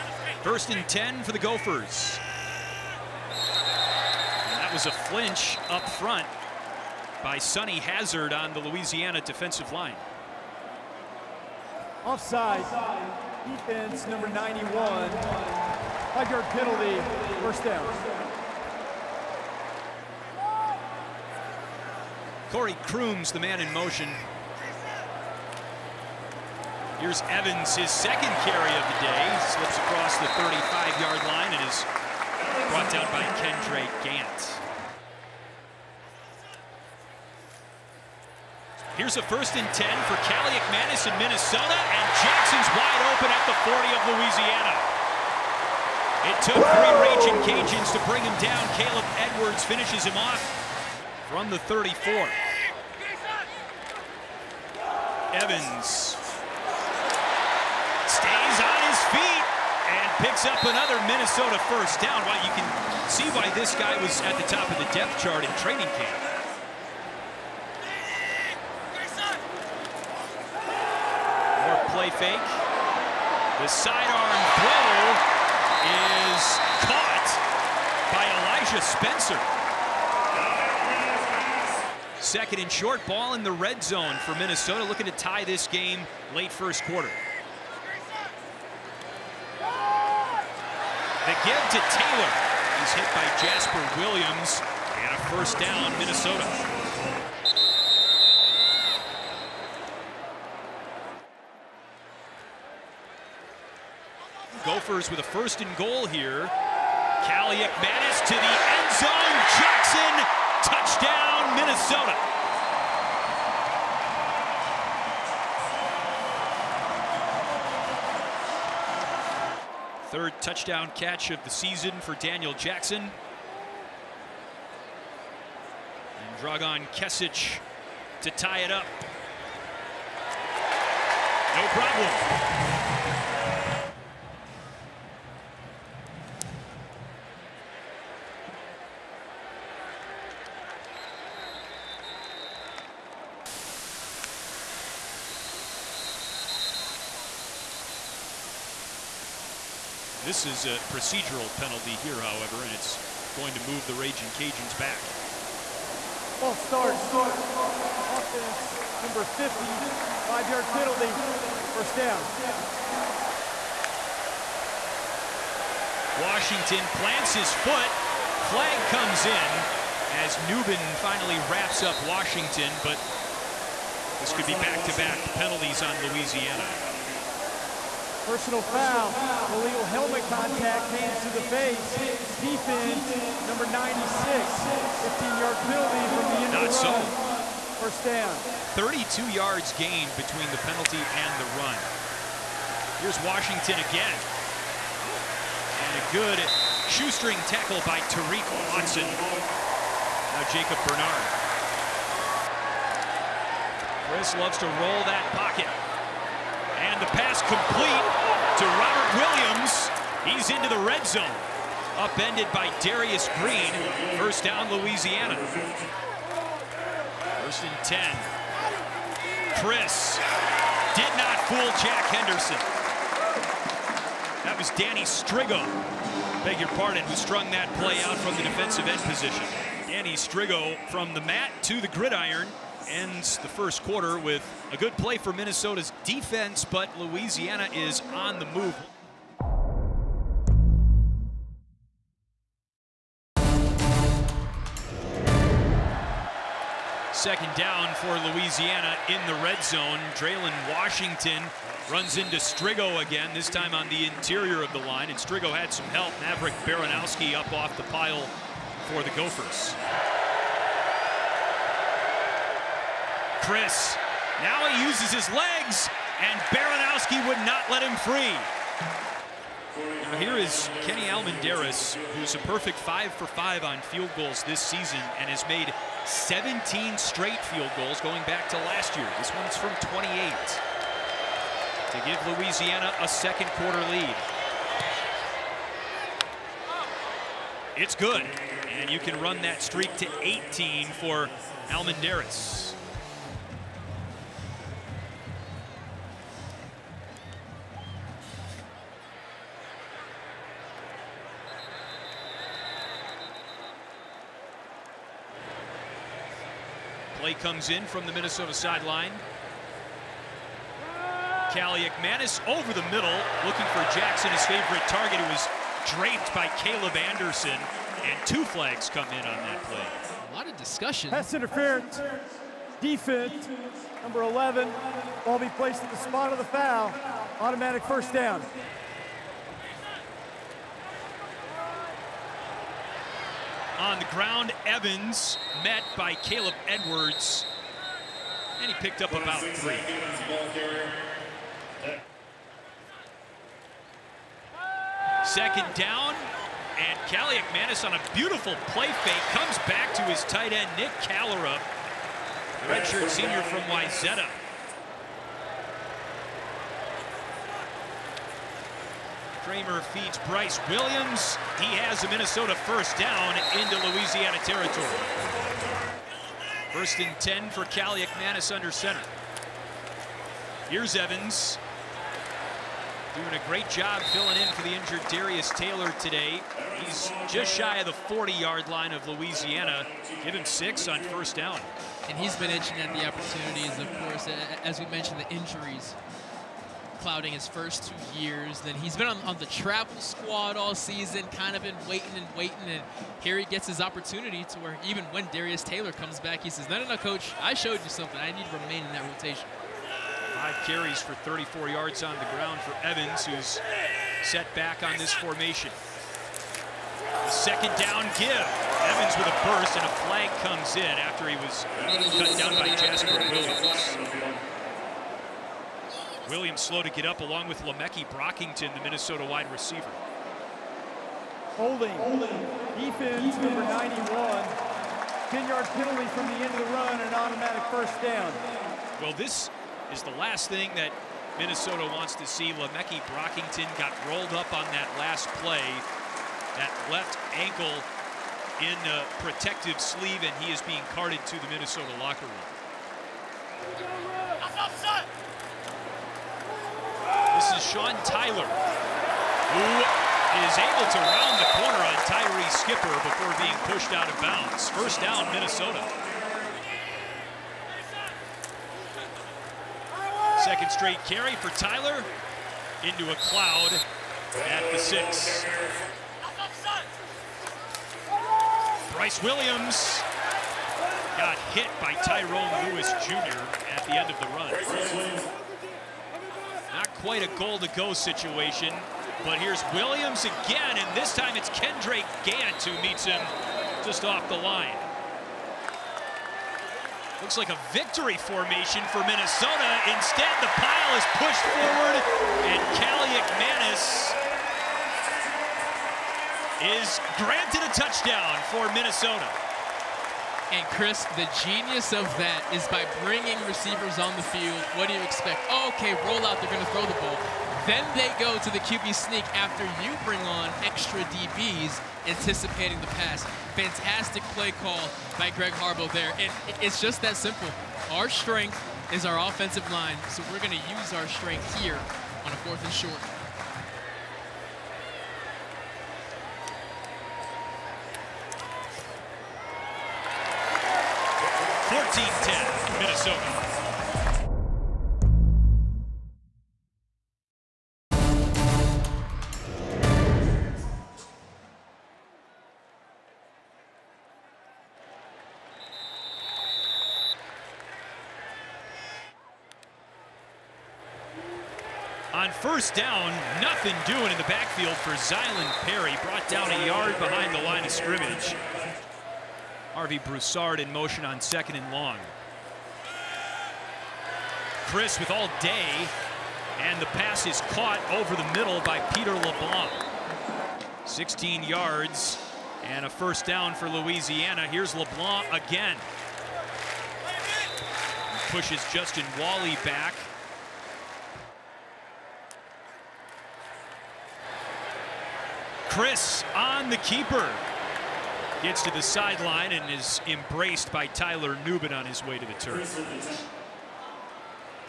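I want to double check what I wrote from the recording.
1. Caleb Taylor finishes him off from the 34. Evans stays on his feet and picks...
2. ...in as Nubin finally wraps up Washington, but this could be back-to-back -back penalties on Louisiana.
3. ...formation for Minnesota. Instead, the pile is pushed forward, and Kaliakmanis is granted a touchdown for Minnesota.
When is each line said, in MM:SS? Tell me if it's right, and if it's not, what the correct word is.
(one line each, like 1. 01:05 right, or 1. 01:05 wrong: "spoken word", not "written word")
1. 00:48 wrong: "Edwards", not "Taylor"
2. 02:49 right
3. 08:08 right.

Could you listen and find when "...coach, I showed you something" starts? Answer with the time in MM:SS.
06:36.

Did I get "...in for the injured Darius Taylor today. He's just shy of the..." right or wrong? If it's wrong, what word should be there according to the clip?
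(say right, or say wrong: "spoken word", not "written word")
right.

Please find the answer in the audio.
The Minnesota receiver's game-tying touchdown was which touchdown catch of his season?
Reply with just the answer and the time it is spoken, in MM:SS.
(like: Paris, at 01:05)
Third, at 02:00.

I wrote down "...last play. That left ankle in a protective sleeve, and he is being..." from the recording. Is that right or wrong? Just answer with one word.
right.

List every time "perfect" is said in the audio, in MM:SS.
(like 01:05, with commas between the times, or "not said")
04:32.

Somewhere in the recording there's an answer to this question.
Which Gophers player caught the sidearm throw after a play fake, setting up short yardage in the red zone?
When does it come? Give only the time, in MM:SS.
01:18.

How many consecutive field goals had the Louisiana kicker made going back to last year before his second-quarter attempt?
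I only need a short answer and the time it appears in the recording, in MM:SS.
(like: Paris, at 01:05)
17, at 04:36.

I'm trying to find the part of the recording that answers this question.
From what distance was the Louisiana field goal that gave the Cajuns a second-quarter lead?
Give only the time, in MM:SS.
04:39.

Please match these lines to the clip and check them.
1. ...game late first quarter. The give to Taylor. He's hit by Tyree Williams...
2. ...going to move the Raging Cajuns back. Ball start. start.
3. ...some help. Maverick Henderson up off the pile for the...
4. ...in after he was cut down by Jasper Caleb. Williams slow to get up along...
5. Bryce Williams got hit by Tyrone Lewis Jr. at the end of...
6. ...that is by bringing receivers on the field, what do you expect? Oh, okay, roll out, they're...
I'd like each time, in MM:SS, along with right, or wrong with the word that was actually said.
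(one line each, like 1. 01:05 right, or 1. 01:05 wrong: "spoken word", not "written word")
1. 01:25 wrong: "Jasper", not "Tyree"
2. 02:33 right
3. 04:15 wrong: "Baranowski", not "Henderson"
4. 06:50 wrong: "Williams", not "Caleb"
5. 07:48 right
6. 08:22 right.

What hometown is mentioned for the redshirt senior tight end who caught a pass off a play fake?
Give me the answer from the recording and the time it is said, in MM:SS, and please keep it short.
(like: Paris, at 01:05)
Wayzata, at 05:53.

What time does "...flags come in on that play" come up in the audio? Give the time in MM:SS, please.
05:18.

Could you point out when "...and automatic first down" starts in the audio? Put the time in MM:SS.
07:07.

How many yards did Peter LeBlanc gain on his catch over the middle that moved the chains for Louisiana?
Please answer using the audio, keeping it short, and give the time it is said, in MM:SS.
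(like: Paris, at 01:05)
16, at 09:30.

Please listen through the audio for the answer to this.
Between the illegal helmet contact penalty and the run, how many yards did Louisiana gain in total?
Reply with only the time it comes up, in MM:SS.
03:08.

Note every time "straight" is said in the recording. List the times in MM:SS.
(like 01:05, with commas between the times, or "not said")
04:36, 07:40.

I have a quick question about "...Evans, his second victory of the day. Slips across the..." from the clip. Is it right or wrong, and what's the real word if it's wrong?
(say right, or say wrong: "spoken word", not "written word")
wrong: "carry", not "victory".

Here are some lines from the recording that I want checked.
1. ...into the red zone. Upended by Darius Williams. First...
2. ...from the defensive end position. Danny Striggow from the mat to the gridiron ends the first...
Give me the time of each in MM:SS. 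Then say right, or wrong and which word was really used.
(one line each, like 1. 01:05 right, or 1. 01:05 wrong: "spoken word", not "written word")
1. 03:30 wrong: "Green", not "Williams"
2. 03:48 right.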